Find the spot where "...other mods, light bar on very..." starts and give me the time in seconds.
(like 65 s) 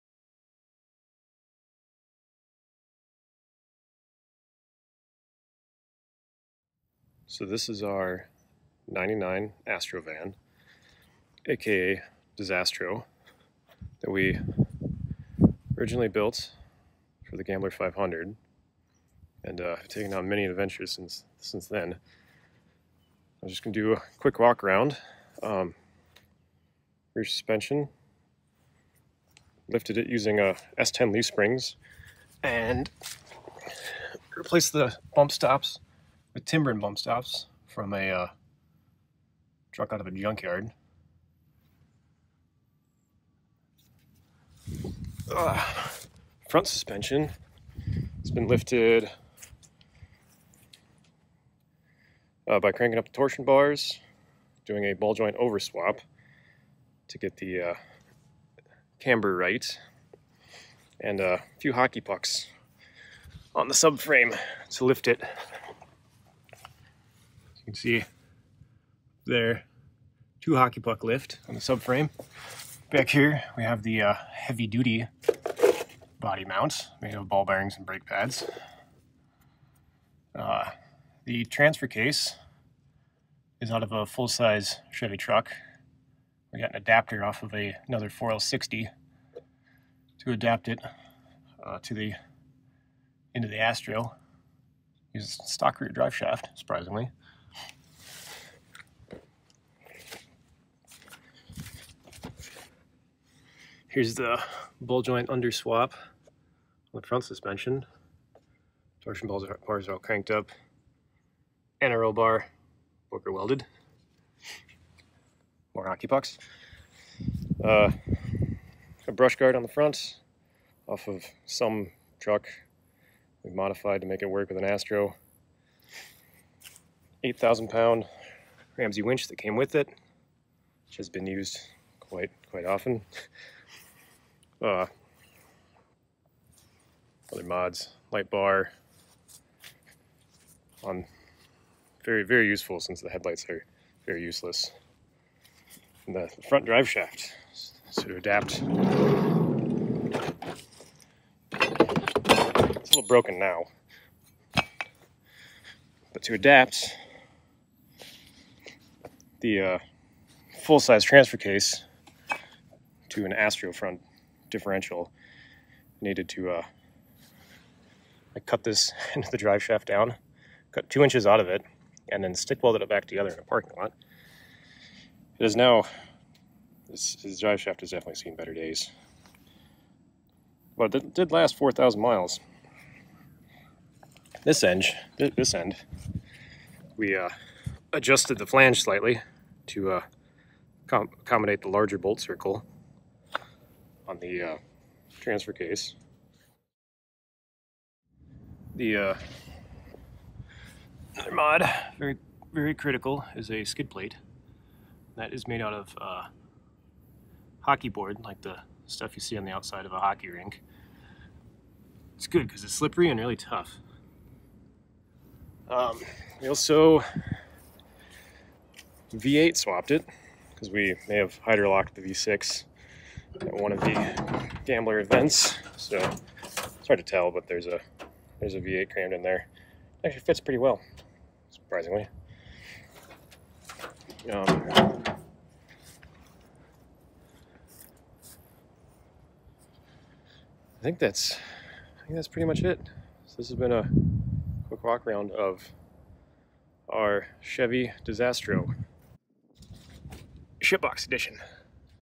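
137 s.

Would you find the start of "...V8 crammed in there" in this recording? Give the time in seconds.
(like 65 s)
228 s.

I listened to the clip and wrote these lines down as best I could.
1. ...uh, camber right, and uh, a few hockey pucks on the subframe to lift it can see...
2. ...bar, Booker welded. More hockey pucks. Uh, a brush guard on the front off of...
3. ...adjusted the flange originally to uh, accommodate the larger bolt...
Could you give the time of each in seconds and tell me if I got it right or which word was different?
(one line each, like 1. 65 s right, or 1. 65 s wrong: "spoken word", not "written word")
1. 57 s right
2. 112 s right
3. 187 s wrong: "slightly", not "originally".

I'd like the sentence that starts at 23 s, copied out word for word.
I'm just gonna do a quick walk around.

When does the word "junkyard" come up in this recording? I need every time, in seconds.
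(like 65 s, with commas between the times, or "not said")
40 s.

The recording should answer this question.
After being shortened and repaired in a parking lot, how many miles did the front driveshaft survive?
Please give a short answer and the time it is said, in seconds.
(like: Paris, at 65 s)
4,000, at 181 s.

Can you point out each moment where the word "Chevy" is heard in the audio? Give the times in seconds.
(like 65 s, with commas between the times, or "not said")
84 s, 247 s.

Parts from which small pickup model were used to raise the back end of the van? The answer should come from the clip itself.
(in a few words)
S10 leaf springs.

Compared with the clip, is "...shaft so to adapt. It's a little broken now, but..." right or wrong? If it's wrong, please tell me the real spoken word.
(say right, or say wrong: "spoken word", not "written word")
right.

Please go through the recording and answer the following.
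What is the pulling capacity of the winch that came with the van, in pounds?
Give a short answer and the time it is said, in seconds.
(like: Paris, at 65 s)
8,000, at 127 s.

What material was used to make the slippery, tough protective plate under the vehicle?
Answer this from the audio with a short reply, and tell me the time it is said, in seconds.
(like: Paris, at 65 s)
hockey board, at 207 s.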